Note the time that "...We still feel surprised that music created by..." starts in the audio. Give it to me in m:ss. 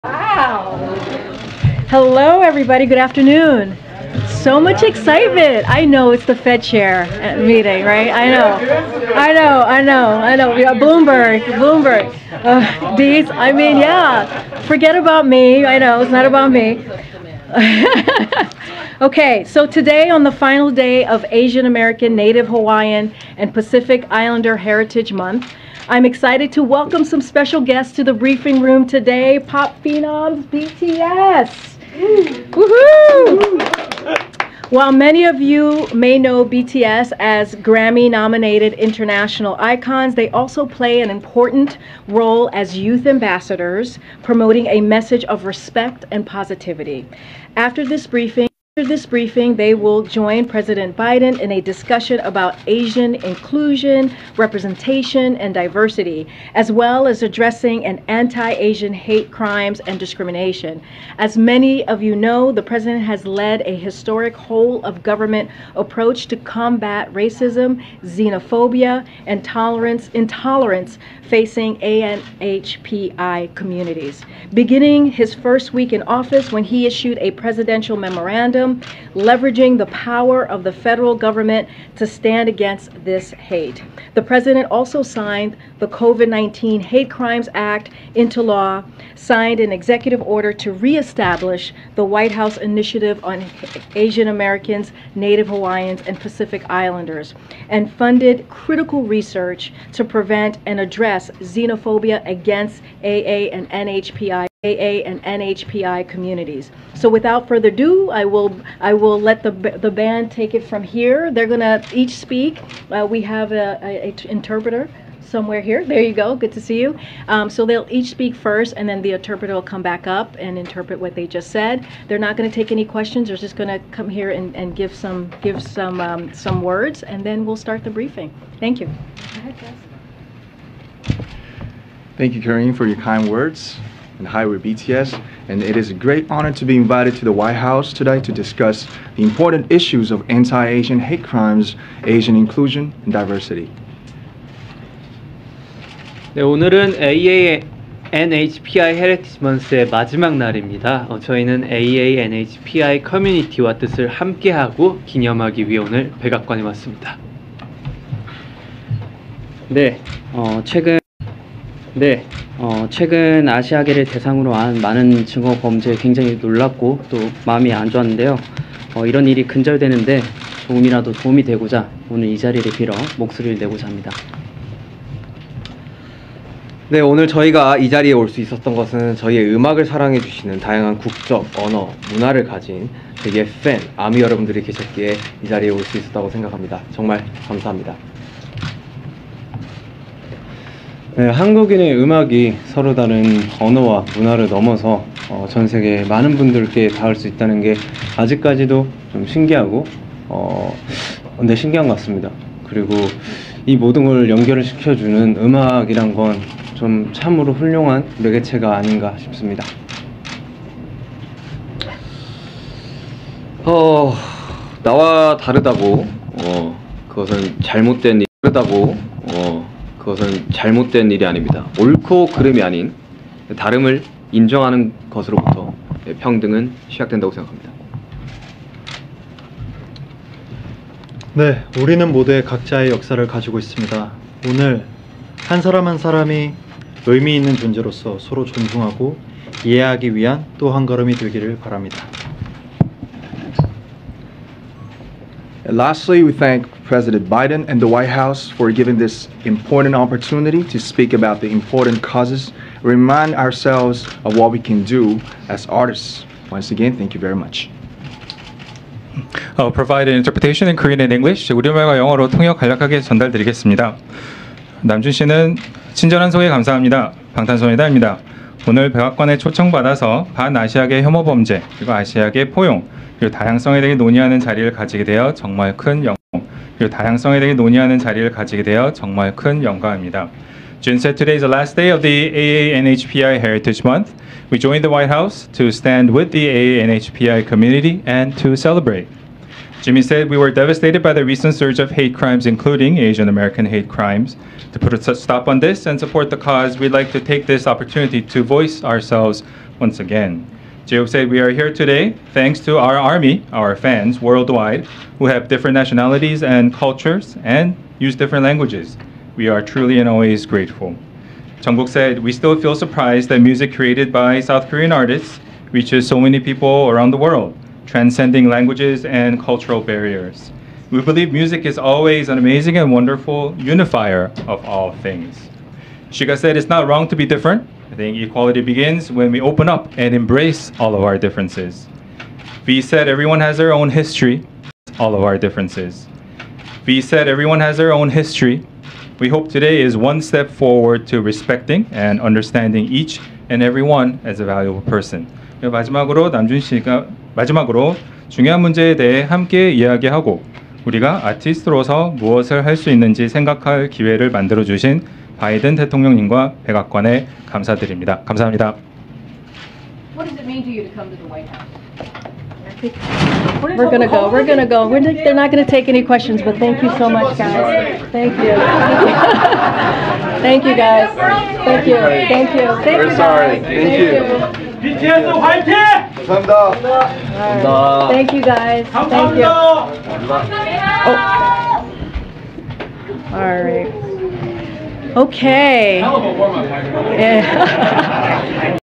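5:12.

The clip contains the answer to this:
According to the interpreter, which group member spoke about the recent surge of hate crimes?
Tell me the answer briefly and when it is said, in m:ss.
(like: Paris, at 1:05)
Jimin, at 4:49.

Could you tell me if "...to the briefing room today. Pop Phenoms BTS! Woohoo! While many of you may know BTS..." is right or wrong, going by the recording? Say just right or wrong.
right.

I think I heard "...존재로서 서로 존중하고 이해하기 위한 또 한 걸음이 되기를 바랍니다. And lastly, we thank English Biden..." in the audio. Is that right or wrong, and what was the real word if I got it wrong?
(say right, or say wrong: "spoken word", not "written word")
wrong: "President", not "English".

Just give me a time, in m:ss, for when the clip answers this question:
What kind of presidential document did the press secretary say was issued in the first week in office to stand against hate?
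1:17.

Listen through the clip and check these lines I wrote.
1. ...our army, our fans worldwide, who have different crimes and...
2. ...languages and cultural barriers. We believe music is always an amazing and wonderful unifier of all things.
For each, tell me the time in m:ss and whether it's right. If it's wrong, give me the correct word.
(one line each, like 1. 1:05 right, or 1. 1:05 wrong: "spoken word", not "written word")
1. 5:02 wrong: "nationalities", not "crimes"
2. 5:18 right.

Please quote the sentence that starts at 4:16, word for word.
Once again, thank you very much.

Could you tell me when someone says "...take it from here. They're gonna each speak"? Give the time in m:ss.
1:50.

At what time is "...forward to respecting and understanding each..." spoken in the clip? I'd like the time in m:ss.
5:40.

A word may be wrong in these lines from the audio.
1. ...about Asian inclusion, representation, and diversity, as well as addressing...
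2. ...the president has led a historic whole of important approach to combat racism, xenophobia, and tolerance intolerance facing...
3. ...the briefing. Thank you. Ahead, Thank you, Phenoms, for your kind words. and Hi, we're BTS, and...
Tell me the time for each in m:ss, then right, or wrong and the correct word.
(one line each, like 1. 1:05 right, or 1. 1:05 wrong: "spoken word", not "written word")
1. 0:52 right
2. 1:02 wrong: "government", not "important"
3. 2:07 wrong: "Karine", not "Phenoms".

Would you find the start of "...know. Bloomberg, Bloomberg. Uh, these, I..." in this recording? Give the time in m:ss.
0:10.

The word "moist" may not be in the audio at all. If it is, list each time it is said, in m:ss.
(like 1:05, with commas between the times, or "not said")
not said.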